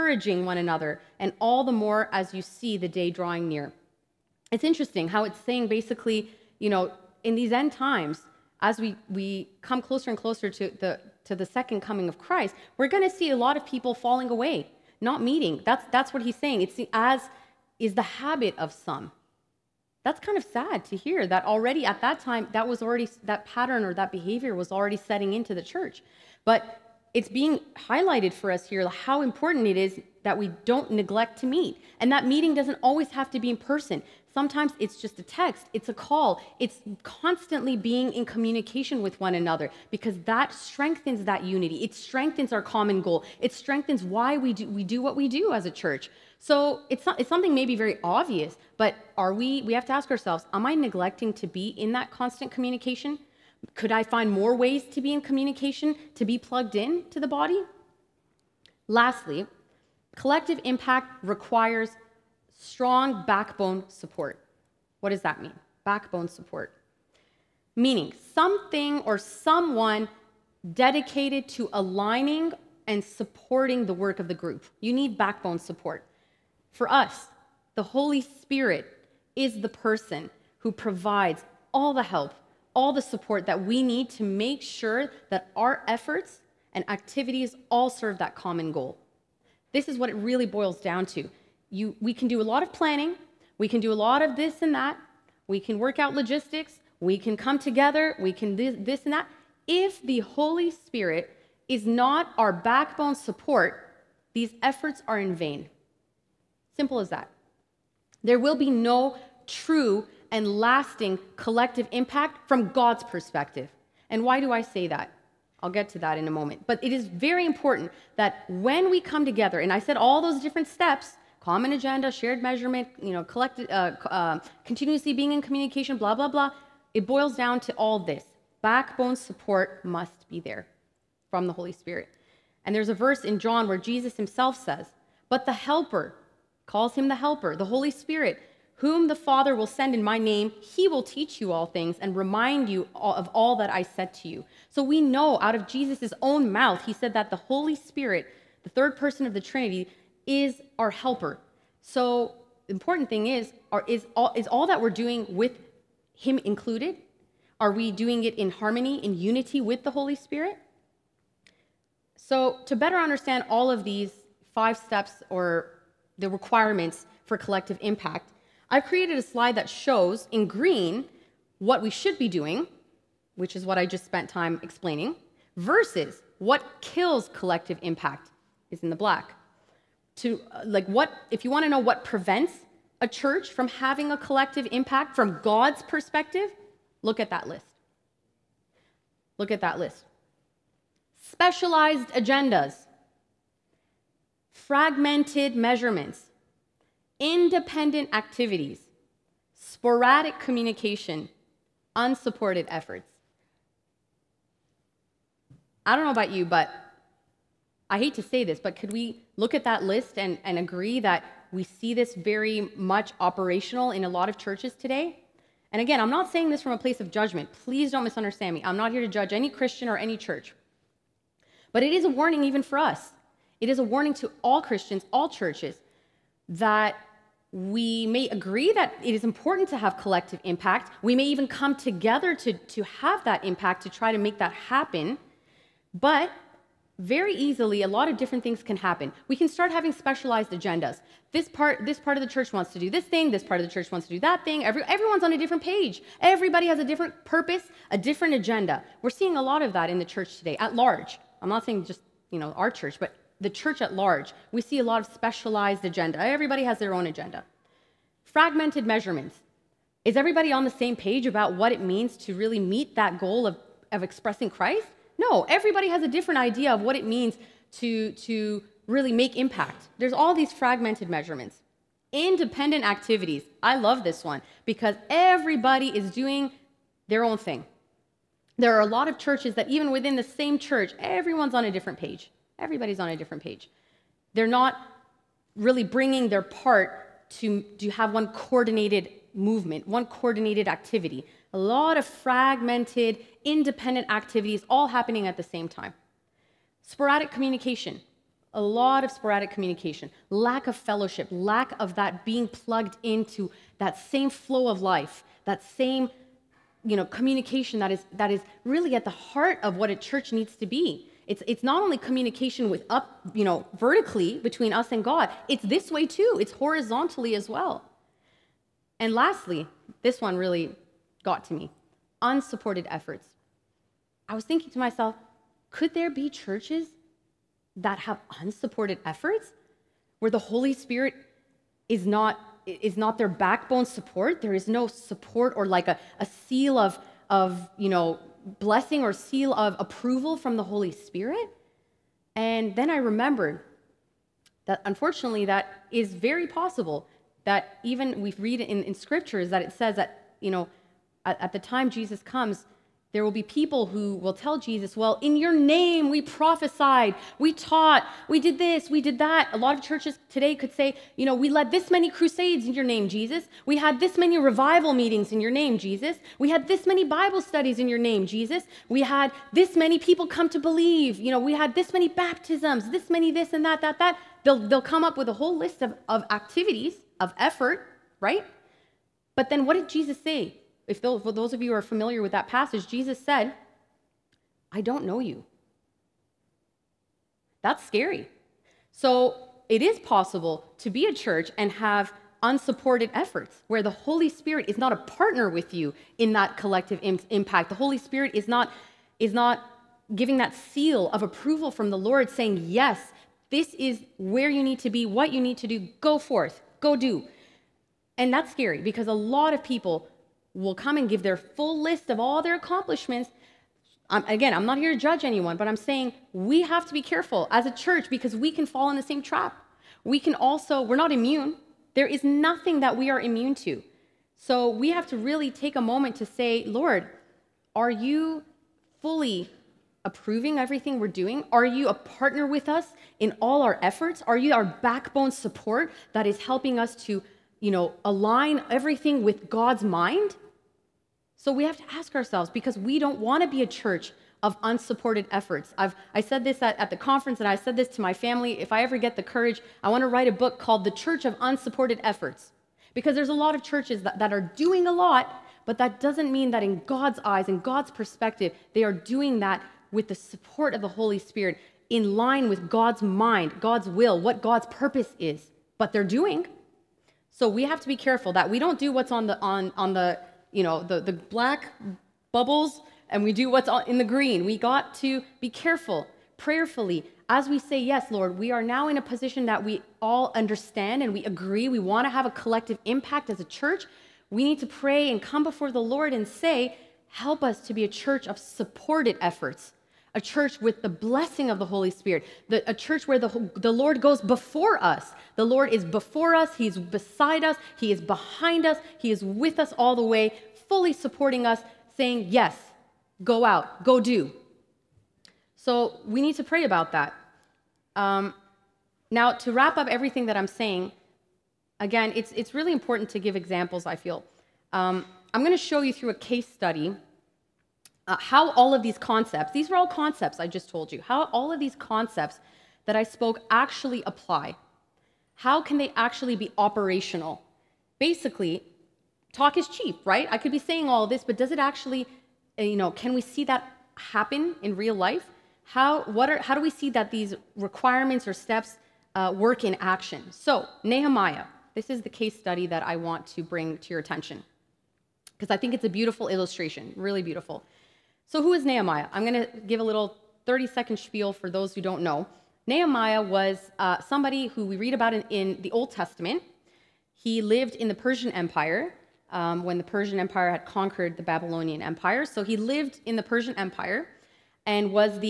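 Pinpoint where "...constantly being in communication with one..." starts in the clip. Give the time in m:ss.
0:37.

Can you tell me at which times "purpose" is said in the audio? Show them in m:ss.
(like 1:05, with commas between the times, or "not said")
4:07, 7:44.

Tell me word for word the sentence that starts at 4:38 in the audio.
There are a lot of churches that, even within the same church, everyone's on a different page.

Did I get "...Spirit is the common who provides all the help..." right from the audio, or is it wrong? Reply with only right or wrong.
wrong.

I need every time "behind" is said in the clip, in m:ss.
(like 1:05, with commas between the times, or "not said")
8:18.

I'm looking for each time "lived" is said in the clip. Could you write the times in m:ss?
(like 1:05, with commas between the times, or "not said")
9:17, 9:22.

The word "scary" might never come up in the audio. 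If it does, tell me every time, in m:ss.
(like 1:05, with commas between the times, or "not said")
6:27, 6:48.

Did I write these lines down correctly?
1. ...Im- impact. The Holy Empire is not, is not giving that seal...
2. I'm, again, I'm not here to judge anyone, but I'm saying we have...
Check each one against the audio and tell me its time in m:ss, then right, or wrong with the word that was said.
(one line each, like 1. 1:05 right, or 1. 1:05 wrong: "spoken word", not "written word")
1. 6:37 wrong: "Spirit", not "Empire"
2. 6:54 right.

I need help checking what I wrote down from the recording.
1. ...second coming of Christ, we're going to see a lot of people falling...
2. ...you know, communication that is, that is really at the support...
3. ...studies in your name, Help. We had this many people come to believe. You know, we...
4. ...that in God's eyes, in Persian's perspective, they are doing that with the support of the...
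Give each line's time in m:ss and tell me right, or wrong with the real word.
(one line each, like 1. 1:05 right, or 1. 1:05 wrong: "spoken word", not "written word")
1. 0:11 right
2. 5:06 wrong: "heart", not "support"
3. 6:07 wrong: "Jesus", not "Help"
4. 7:36 wrong: "God", not "Persian".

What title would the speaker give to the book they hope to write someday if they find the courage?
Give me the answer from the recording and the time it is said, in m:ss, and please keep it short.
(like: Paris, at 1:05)
The Church of Unsupported Efforts, at 7:30.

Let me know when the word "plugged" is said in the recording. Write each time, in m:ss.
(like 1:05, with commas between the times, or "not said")
0:56, 5:02.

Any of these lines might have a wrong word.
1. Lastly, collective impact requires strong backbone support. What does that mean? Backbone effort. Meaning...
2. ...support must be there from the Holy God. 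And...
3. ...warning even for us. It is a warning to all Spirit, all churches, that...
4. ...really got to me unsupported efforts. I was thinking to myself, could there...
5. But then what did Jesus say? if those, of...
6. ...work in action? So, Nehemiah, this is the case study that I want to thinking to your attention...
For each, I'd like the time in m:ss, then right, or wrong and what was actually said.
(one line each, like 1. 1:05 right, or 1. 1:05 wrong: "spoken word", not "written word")
1. 0:58 wrong: "support", not "effort"
2. 2:09 wrong: "Spirit", not "God"
3. 3:42 wrong: "Christians", not "Spirit"
4. 5:20 right
5. 6:19 right
6. 8:59 wrong: "bring", not "thinking".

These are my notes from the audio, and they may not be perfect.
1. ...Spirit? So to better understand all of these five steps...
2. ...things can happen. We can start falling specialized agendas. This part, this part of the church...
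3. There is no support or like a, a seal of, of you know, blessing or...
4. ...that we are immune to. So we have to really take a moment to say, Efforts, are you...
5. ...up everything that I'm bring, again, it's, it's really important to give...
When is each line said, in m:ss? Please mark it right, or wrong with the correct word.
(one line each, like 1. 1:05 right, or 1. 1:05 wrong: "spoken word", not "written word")
1. 2:40 right
2. 3:58 wrong: "having", not "falling"
3. 5:34 right
4. 7:02 wrong: "Lord", not "Efforts"
5. 8:29 wrong: "saying", not "bring".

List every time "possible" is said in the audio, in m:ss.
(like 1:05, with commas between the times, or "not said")
5:46, 6:30.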